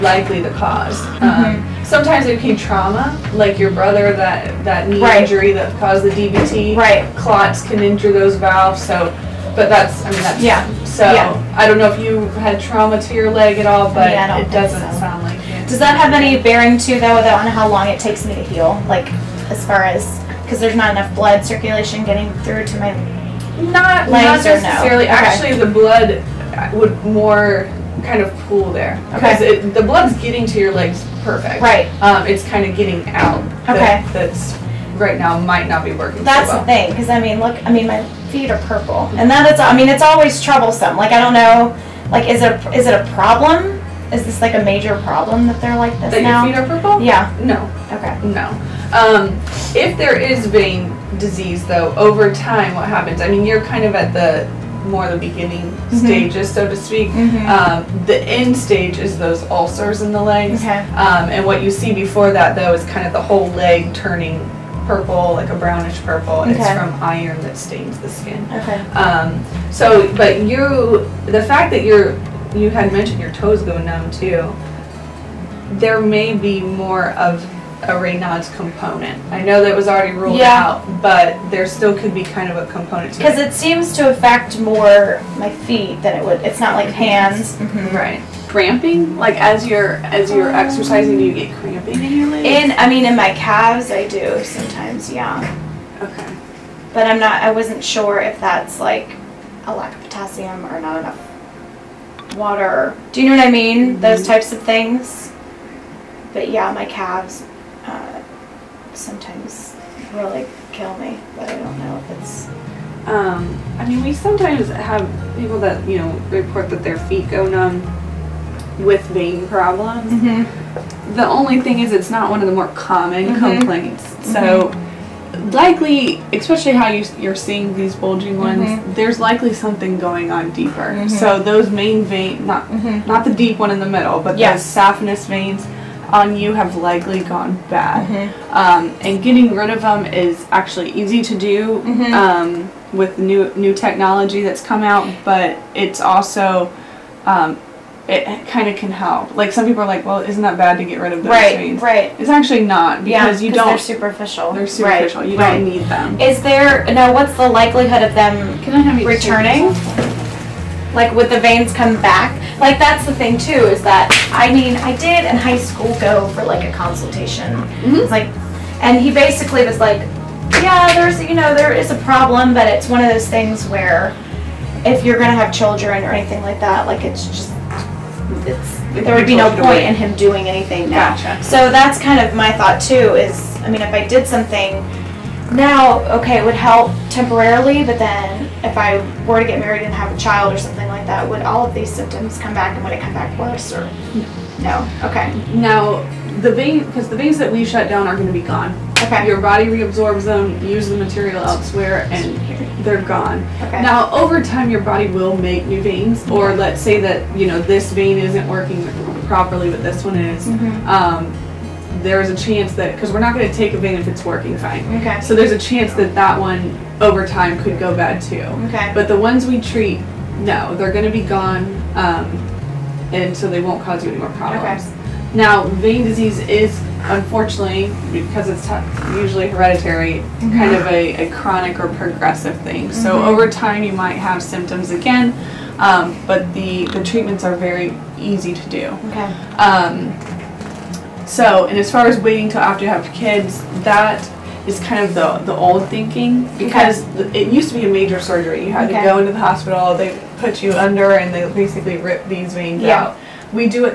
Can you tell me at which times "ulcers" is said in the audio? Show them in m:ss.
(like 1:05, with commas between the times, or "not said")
0:59.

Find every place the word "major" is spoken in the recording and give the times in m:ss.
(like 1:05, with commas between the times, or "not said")
0:44, 4:07.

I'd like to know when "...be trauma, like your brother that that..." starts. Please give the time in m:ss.
0:02.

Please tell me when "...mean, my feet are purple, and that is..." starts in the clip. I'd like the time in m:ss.
0:37.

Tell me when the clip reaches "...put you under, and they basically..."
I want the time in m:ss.
4:10.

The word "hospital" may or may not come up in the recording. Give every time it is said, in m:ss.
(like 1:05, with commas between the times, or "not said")
4:09.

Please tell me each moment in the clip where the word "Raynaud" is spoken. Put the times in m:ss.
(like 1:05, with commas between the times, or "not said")
1:17.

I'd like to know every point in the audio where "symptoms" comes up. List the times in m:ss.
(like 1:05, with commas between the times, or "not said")
3:11, 3:54.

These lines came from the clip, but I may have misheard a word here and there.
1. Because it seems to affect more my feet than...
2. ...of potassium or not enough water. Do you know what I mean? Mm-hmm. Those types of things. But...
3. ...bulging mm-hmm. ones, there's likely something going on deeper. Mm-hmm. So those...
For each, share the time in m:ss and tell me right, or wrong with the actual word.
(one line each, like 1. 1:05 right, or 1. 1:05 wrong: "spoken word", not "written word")
1. 1:23 right
2. 1:39 right
3. 2:07 right.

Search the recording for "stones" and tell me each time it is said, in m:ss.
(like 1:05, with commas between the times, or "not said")
not said.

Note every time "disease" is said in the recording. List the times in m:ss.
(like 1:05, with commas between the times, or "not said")
0:51, 3:46.